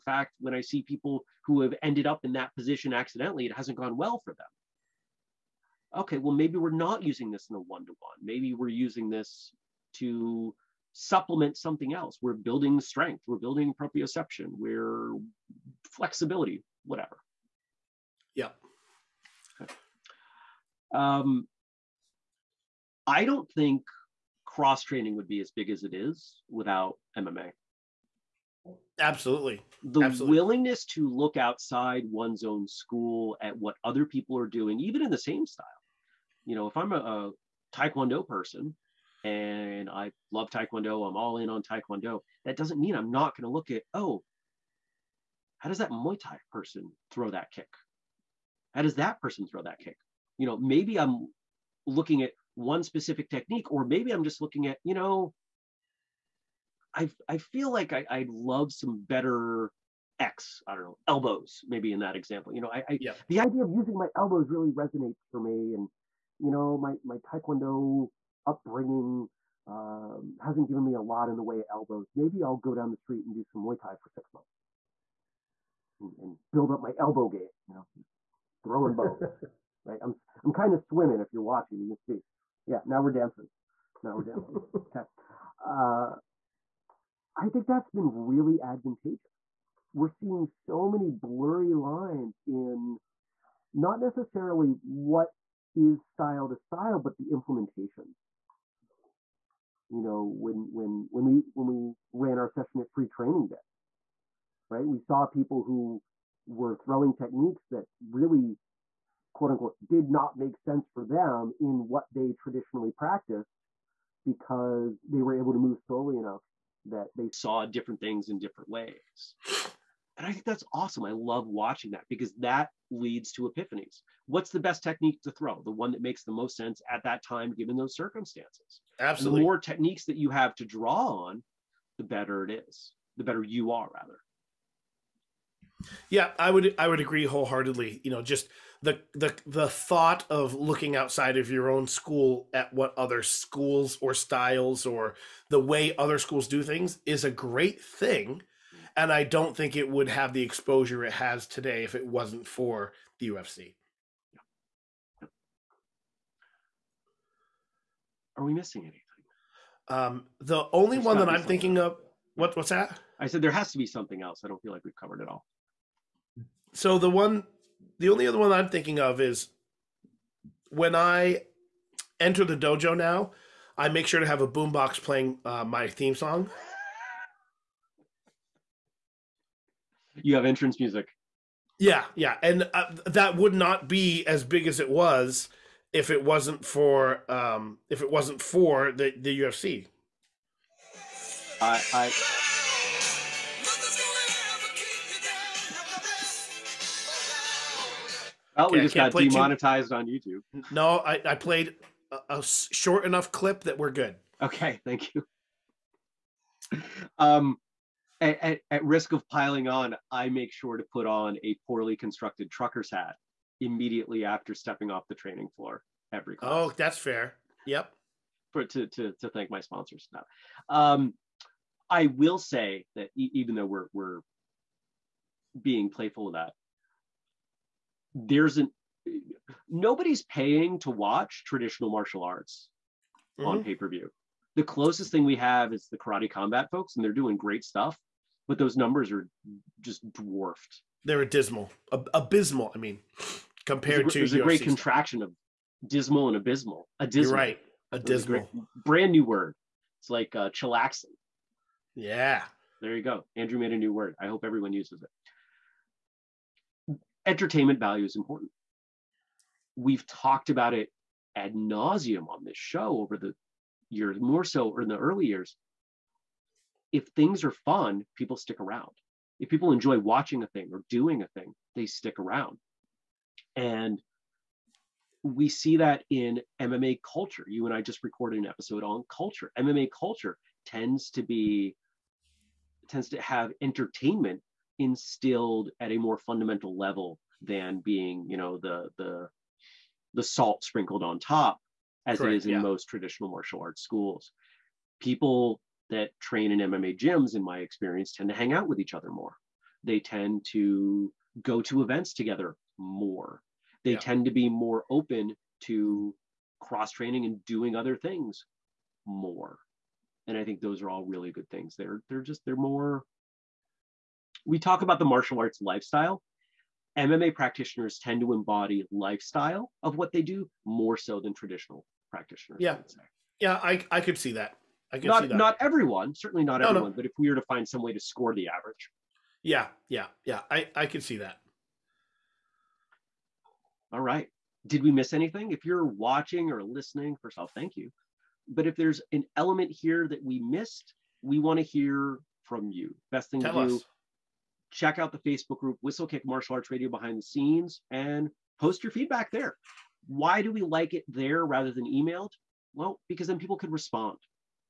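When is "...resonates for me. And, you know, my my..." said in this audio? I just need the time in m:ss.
1:04.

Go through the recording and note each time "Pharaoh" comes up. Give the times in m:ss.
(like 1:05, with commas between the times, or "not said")
not said.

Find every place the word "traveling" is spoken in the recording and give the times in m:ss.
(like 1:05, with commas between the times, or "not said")
not said.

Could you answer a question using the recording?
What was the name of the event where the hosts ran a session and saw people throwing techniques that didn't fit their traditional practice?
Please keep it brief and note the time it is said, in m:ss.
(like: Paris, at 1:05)
Free Training Day, at 1:42.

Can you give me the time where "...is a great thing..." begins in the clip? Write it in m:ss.
2:27.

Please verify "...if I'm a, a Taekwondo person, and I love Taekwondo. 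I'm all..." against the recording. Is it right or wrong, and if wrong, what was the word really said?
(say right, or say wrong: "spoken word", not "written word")
right.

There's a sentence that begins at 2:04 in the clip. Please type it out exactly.
What's the best technique to throw?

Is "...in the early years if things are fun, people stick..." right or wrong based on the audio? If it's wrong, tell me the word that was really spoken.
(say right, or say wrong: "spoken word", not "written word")
right.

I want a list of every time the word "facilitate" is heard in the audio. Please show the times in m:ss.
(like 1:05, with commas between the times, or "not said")
not said.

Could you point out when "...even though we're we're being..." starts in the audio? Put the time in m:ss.
3:43.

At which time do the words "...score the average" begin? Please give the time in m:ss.
5:27.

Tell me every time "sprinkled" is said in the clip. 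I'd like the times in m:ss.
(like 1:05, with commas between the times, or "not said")
4:50.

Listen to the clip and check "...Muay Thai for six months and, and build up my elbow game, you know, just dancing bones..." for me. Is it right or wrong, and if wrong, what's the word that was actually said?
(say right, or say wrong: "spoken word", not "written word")
wrong: "throwing", not "dancing".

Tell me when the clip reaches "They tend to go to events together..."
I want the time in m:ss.
4:59.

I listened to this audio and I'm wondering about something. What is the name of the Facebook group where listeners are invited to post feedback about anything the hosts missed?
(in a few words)
Whistlekick Martial Arts Radio Behind the Scenes.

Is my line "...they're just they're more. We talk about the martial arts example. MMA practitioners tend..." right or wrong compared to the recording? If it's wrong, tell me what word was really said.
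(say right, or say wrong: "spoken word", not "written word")
wrong: "lifestyle", not "example".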